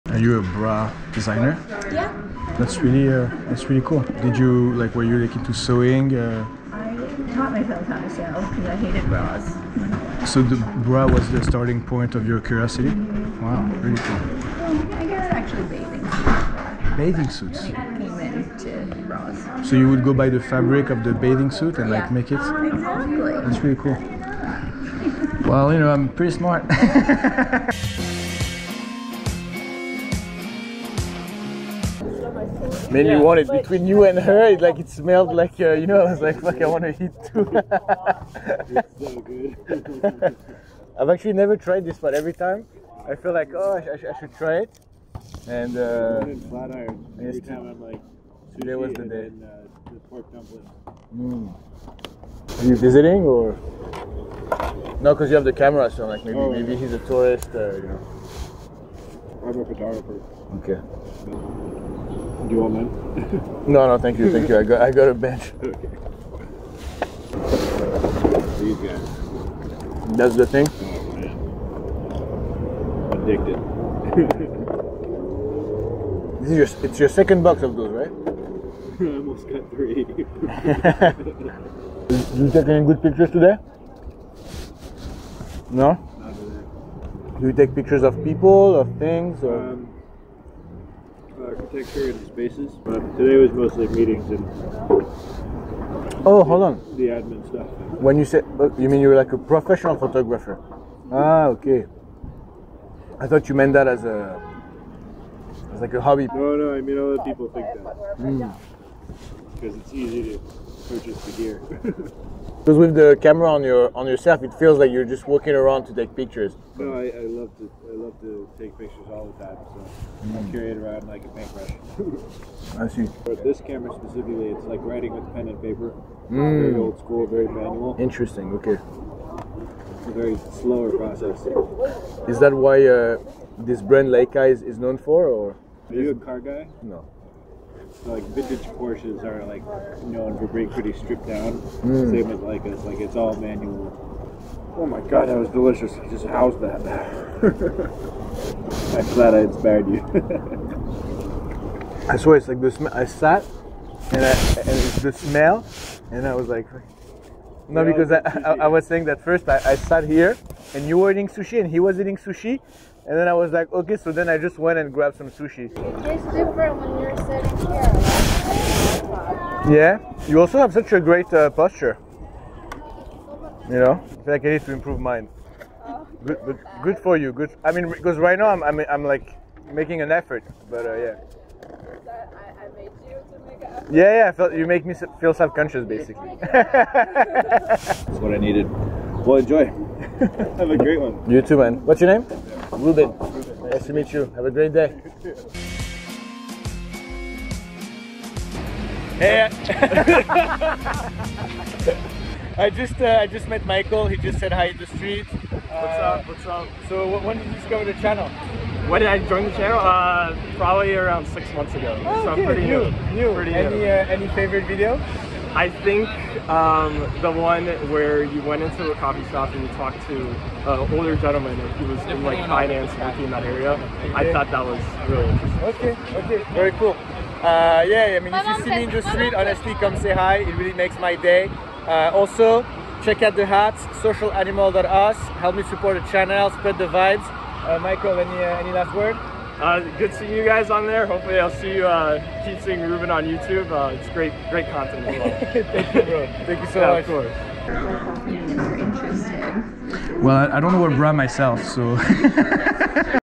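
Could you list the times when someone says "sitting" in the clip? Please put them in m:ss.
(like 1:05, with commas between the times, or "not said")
2:47.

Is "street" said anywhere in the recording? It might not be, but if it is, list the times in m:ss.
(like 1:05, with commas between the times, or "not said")
3:24, 3:49.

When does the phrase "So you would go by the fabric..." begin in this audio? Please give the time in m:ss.
0:19.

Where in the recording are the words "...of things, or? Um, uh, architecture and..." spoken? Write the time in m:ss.
1:28.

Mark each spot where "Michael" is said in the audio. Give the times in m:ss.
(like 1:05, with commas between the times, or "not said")
3:23, 3:57.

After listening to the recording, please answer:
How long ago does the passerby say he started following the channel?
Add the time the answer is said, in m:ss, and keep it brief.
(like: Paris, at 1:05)
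6 months, at 3:31.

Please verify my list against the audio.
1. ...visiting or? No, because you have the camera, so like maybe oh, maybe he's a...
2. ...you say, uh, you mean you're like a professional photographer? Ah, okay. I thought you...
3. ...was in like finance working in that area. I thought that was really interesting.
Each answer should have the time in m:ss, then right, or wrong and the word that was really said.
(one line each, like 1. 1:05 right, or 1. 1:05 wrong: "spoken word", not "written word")
1. 0:52 right
2. 1:38 right
3. 3:41 right.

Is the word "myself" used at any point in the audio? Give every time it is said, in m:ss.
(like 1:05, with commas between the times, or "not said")
0:07, 4:11.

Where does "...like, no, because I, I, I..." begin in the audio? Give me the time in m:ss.
2:36.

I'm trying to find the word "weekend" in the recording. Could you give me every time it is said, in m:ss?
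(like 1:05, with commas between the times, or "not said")
not said.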